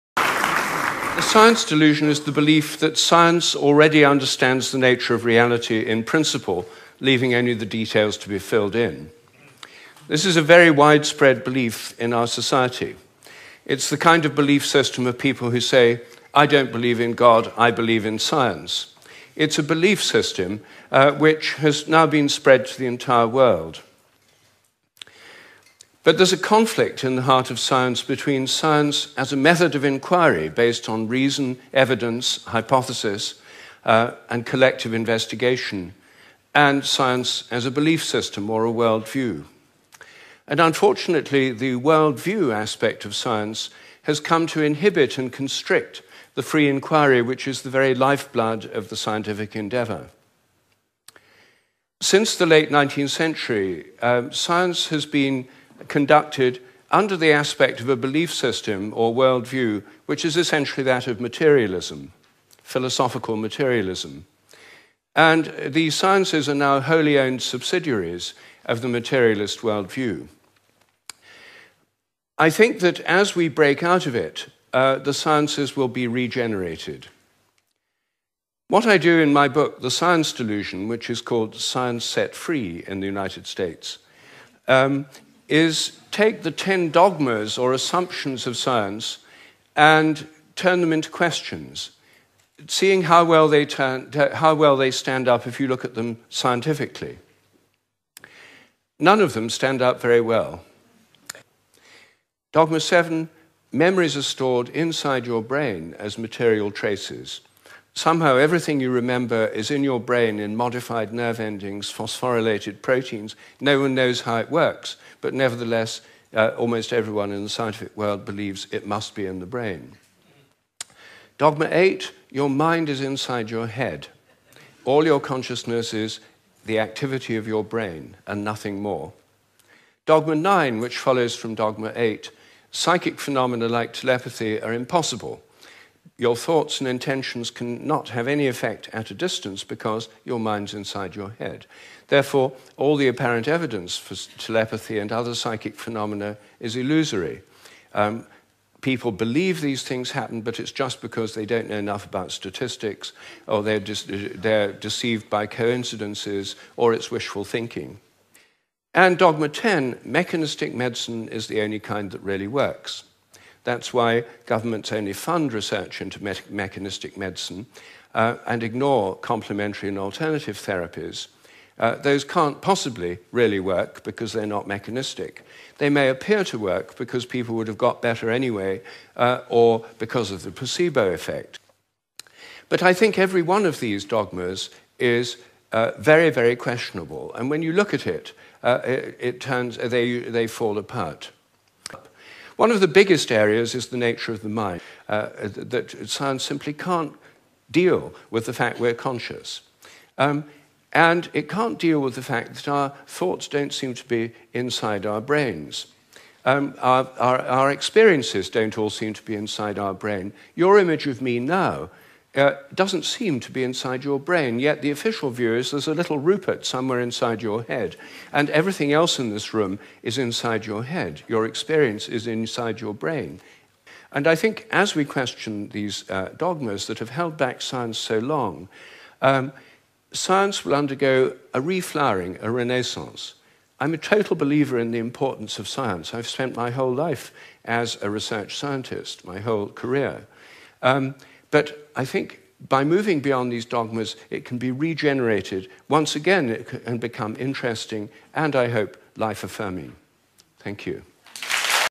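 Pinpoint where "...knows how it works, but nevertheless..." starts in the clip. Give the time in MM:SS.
01:53.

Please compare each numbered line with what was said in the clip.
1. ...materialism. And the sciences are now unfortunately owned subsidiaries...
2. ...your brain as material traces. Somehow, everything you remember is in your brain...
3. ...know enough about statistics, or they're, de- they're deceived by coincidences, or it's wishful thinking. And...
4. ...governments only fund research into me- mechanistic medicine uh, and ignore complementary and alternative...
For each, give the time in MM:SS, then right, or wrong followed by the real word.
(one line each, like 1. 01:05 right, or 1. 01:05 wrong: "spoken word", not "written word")
1. 01:03 wrong: "wholly", not "unfortunately"
2. 01:45 right
3. 02:31 right
4. 02:44 right.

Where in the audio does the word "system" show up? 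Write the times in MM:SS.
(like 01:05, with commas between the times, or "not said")
00:14, 00:20, 00:38, 00:58.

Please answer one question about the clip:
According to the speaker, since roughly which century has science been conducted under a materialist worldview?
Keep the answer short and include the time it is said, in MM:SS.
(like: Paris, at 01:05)
Late 19th century, at 00:52.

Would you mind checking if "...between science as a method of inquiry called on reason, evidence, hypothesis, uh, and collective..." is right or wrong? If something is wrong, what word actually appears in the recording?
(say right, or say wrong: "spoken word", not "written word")
wrong: "based", not "called".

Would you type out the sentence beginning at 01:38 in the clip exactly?
None of them stand up very well.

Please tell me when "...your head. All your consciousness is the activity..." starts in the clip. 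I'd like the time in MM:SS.
02:03.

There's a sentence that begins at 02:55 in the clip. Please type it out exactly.
They may appear to work because people would have got better anyway uh, or because of the placebo effect.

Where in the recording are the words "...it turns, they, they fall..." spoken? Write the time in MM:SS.
03:09.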